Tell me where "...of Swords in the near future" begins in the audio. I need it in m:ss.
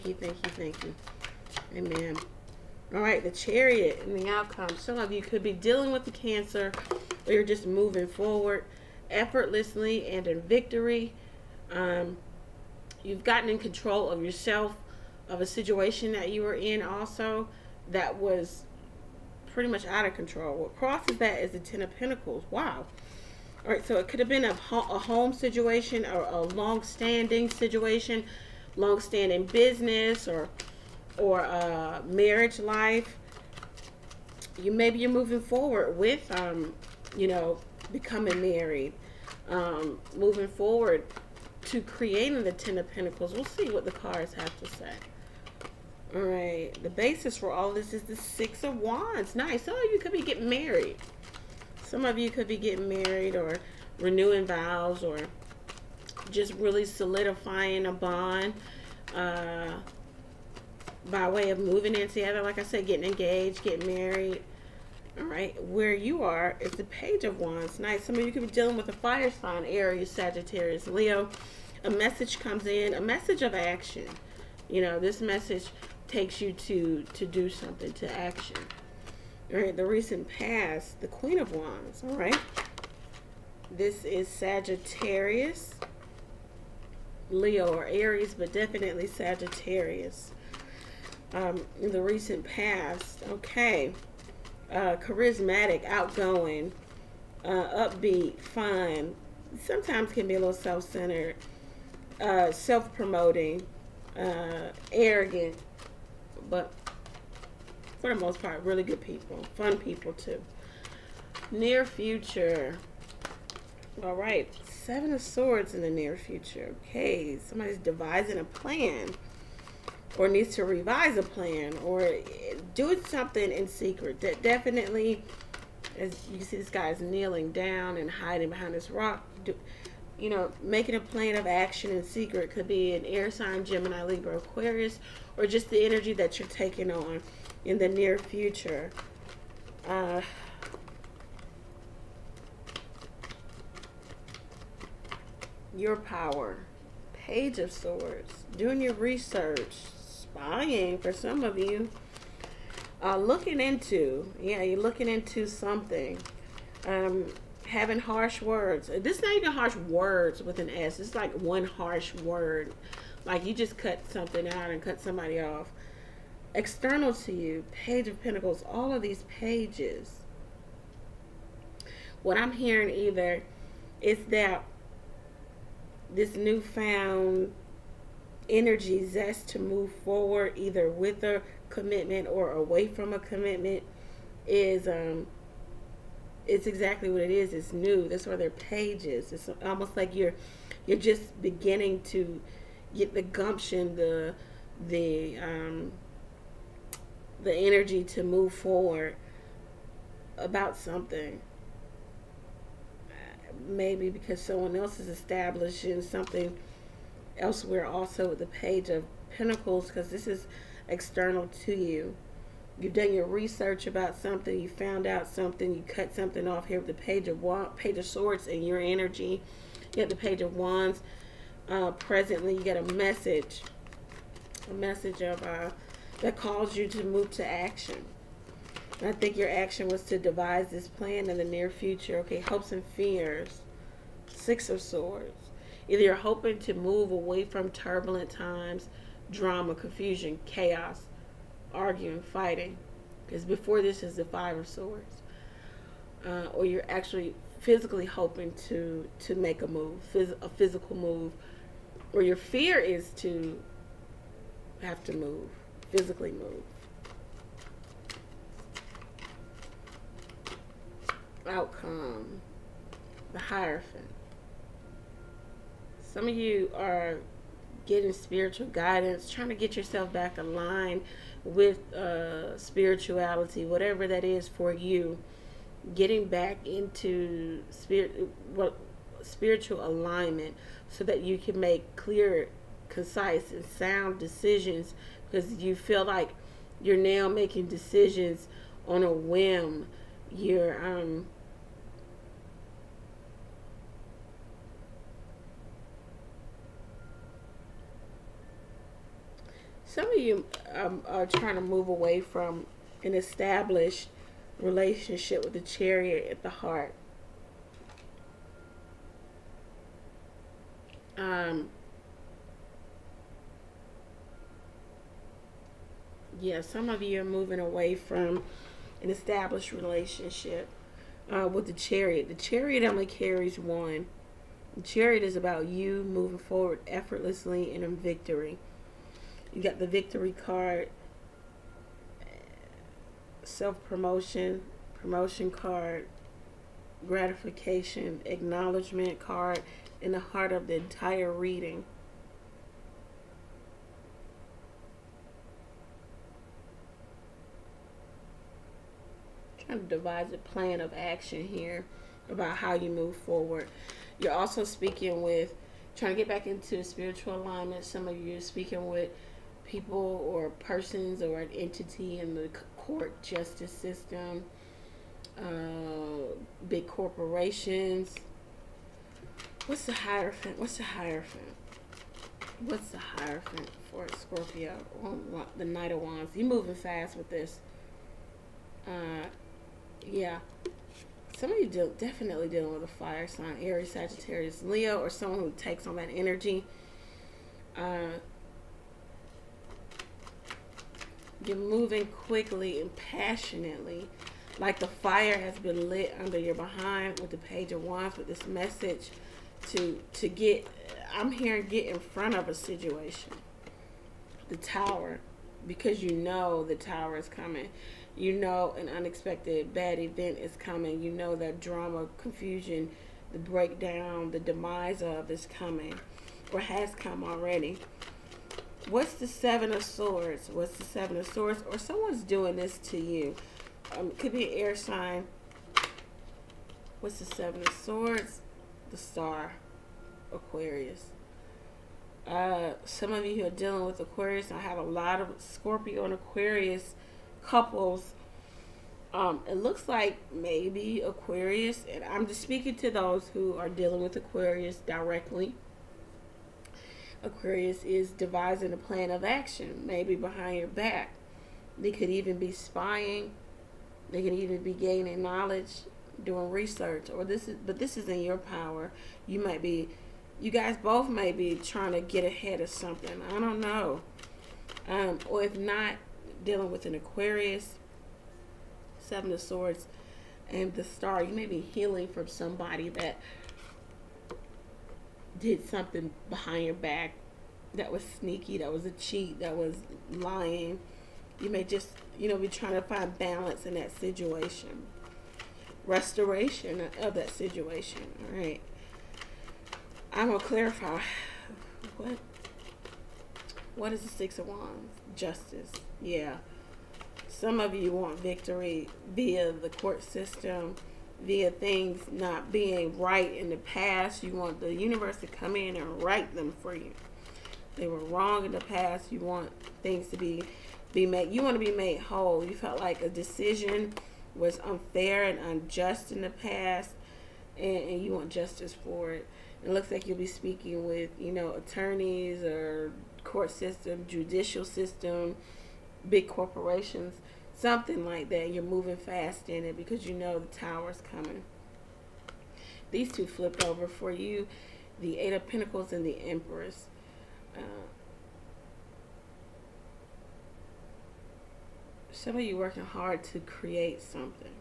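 1:55.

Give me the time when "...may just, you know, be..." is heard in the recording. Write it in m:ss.
8:01.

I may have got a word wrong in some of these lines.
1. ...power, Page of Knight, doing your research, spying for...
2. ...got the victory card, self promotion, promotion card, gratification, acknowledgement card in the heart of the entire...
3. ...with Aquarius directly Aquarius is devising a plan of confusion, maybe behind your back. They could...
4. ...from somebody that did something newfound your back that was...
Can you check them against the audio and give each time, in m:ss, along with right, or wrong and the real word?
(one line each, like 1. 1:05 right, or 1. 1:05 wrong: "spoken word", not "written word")
1. 2:25 wrong: "Swords", not "Knight"
2. 5:29 right
3. 7:24 wrong: "action", not "confusion"
4. 7:52 wrong: "behind", not "newfound".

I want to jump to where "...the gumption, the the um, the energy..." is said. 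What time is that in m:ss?
3:13.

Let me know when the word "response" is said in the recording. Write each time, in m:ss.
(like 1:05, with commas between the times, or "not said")
not said.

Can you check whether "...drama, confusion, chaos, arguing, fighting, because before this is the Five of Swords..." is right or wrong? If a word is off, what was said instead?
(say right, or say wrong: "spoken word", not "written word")
right.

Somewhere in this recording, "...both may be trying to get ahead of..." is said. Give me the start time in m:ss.
7:40.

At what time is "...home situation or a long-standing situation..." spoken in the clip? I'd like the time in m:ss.
0:24.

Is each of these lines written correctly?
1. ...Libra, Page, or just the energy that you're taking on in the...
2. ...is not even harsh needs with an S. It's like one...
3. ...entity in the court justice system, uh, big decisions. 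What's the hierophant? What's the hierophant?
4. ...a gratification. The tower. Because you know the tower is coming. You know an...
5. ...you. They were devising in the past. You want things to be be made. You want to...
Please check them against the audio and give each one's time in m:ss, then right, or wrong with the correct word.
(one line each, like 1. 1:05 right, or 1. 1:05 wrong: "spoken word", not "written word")
1. 2:14 wrong: "Aquarius", not "Page"
2. 2:39 wrong: "words", not "needs"
3. 6:01 wrong: "corporations", not "decisions"
4. 6:42 wrong: "situation", not "gratification"
5. 8:26 wrong: "wrong", not "devising".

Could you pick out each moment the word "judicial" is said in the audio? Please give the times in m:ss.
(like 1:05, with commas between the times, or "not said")
8:44.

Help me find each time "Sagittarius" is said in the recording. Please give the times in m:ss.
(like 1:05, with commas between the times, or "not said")
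1:10, 1:24, 1:29, 6:23.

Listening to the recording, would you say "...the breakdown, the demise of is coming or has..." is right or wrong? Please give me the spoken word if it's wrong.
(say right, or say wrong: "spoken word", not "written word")
right.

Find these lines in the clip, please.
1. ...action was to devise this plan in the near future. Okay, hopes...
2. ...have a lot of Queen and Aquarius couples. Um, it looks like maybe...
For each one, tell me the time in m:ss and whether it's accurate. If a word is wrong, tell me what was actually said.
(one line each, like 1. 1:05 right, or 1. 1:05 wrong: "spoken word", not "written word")
1. 3:49 right
2. 7:14 wrong: "Scorpio", not "Queen".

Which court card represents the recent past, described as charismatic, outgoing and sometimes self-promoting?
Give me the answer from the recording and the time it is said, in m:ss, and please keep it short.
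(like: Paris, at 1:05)
Queen of Wands, at 1:20.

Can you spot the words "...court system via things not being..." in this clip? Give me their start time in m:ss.
8:19.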